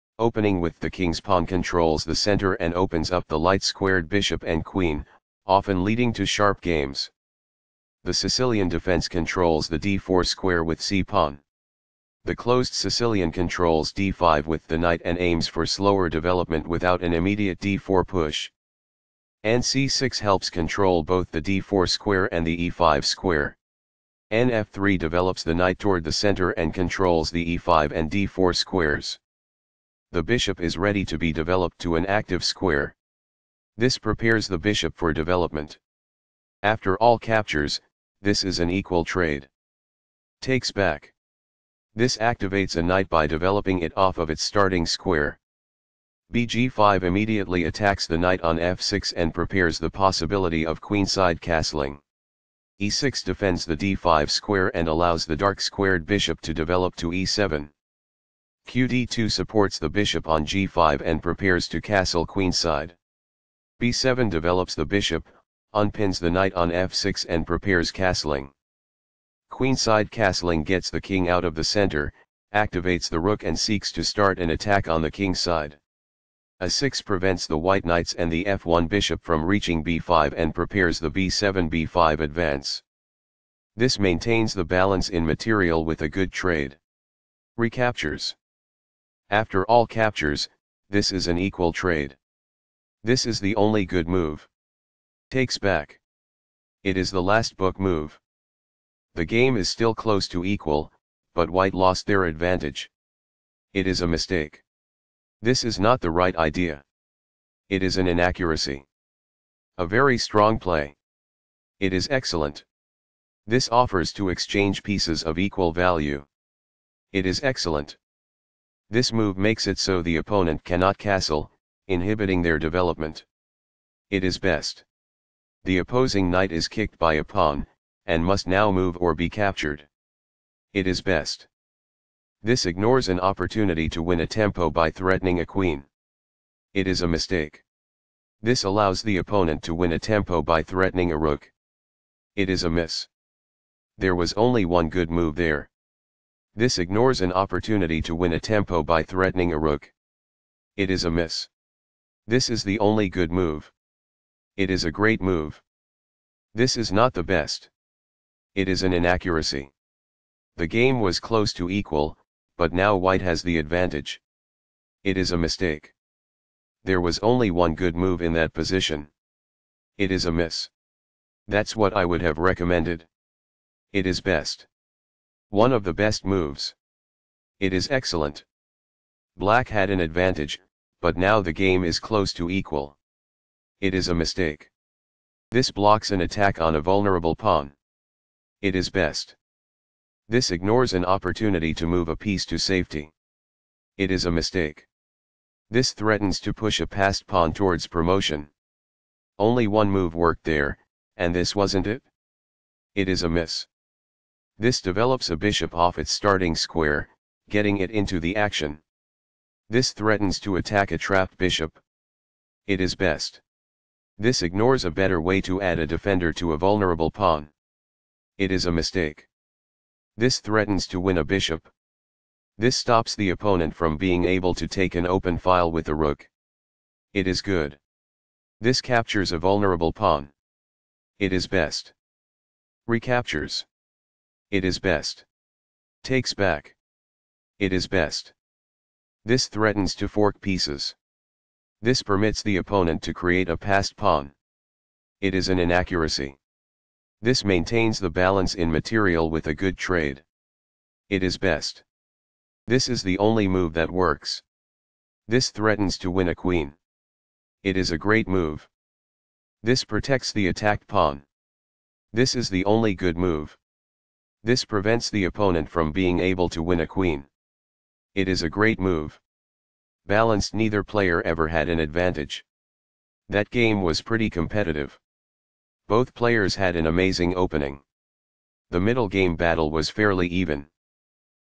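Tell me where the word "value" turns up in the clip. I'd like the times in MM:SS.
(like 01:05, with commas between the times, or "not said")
01:55.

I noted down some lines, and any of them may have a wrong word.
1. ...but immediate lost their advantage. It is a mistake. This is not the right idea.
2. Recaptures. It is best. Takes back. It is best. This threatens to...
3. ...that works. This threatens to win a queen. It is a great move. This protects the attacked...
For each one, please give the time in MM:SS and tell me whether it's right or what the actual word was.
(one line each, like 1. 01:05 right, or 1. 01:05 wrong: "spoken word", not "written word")
1. 01:41 wrong: "white", not "immediate"
2. 03:52 right
3. 04:13 right.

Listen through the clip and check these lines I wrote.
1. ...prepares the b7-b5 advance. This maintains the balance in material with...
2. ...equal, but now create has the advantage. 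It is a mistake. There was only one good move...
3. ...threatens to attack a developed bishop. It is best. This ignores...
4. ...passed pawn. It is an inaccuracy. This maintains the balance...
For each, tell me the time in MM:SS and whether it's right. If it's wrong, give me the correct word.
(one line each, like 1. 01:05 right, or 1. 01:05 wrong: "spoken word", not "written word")
1. 01:20 right
2. 02:41 wrong: "white", not "create"
3. 03:29 wrong: "trapped", not "developed"
4. 04:03 right.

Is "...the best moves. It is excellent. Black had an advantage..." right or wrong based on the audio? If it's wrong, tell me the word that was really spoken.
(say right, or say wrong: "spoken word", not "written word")
right.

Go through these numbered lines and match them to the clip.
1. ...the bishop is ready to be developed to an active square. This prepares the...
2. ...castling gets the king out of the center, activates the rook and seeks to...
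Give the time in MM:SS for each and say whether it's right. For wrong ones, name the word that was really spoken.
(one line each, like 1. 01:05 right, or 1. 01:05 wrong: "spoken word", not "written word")
1. 00:30 right
2. 01:10 right.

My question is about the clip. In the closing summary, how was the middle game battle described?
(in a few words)
Fairly even.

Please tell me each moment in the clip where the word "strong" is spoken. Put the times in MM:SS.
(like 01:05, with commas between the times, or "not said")
01:50.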